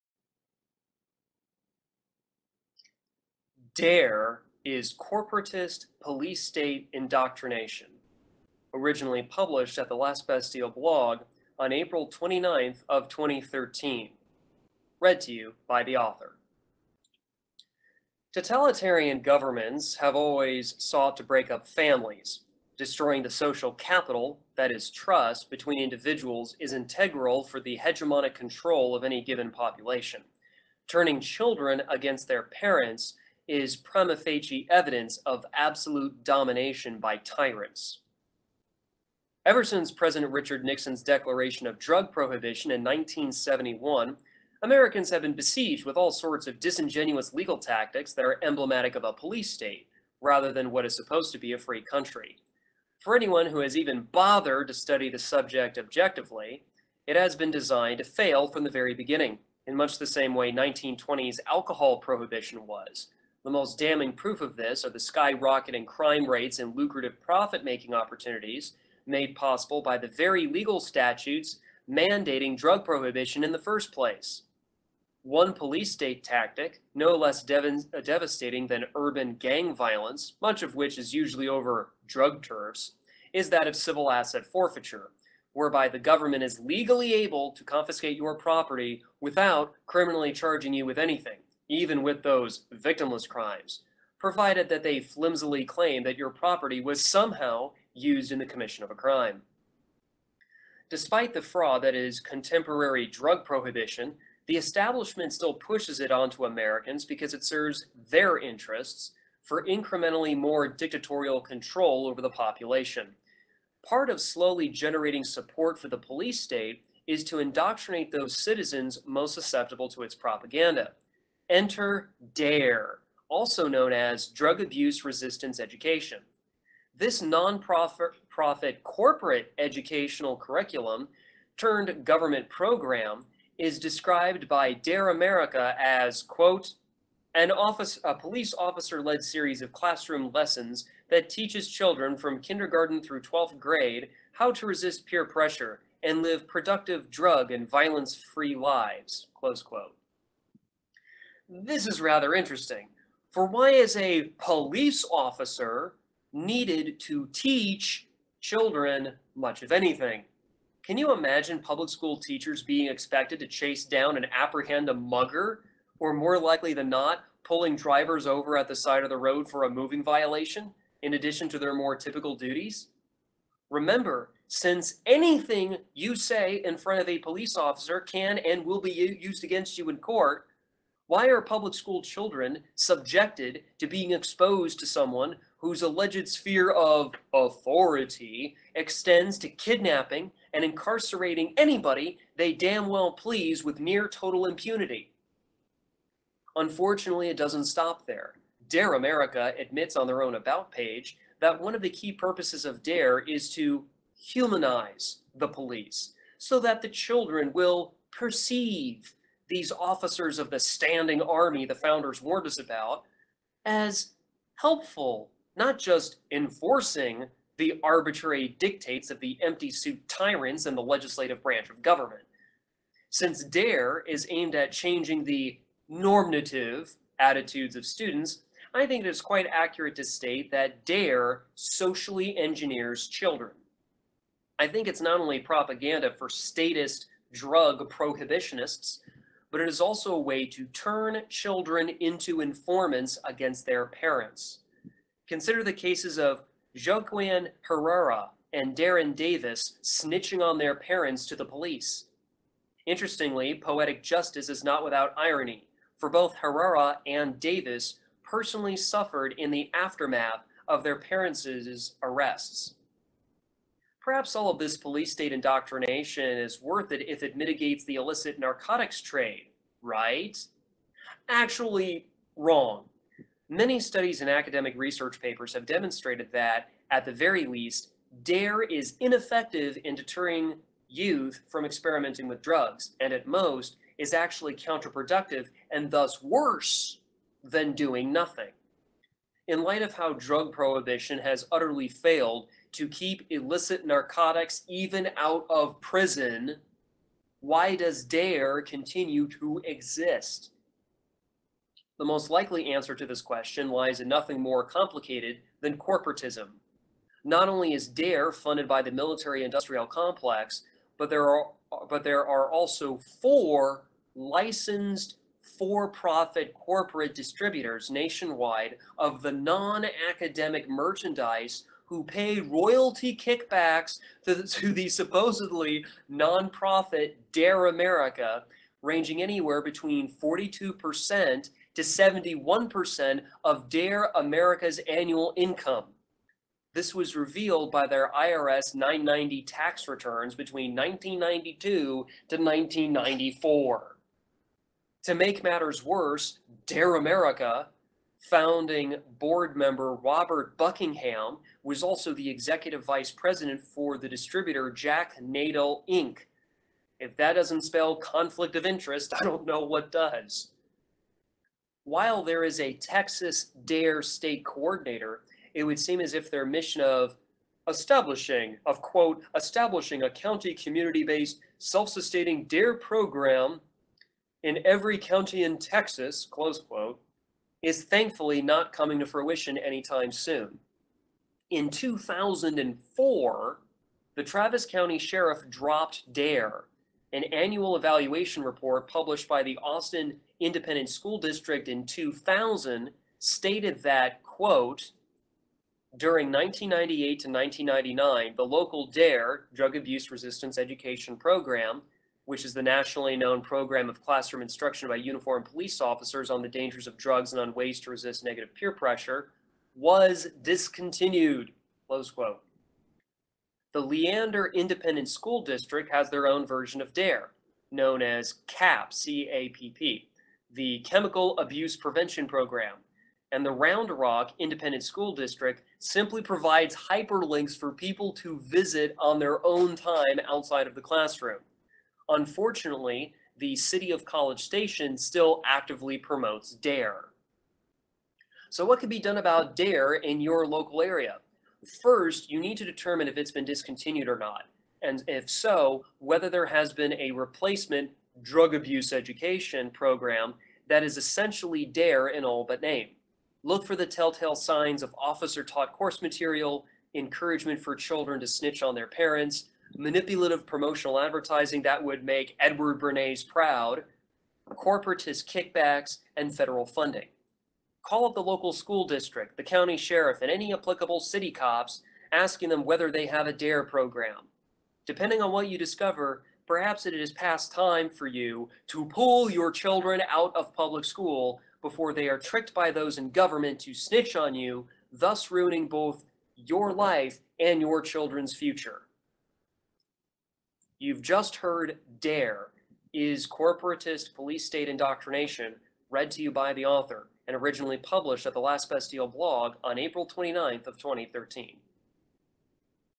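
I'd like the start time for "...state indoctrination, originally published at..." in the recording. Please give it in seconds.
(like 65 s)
6 s.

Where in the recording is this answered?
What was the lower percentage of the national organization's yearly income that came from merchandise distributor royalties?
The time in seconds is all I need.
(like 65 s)
330 s.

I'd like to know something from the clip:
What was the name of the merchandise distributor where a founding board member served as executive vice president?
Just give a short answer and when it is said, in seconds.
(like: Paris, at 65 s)
Jack Nadel Inc., at 354 s.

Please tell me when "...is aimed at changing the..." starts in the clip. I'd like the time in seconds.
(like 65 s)
224 s.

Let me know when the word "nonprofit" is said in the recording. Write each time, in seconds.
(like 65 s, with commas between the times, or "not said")
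127 s, 326 s.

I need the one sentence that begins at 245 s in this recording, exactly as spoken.
Consider the cases of Joaquin Herrera and Darren Davis snitching on their parents to the police.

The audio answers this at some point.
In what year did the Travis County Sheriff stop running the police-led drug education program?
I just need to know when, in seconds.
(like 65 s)
381 s.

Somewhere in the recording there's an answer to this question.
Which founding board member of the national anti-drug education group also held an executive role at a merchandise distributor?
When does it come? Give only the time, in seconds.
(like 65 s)
349 s.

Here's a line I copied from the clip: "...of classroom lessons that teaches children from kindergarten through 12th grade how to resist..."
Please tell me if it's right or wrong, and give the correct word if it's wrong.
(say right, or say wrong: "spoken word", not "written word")
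right.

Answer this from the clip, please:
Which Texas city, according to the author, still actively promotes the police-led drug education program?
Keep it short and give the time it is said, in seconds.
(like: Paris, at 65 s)
College Station, at 434 s.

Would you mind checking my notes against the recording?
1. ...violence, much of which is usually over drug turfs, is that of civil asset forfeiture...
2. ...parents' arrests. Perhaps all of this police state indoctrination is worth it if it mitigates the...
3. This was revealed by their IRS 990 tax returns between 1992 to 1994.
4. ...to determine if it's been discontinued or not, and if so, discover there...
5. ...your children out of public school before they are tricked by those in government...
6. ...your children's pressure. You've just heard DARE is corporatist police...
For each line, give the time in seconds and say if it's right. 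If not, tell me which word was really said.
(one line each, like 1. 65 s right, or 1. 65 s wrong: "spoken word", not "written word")
1. 79 s right
2. 260 s right
3. 336 s right
4. 442 s wrong: "whether", not "discover"
5. 479 s right
6. 487 s wrong: "future", not "pressure".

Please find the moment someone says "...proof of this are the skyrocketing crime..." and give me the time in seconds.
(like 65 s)
64 s.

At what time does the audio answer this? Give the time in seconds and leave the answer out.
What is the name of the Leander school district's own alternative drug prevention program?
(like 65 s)
420 s.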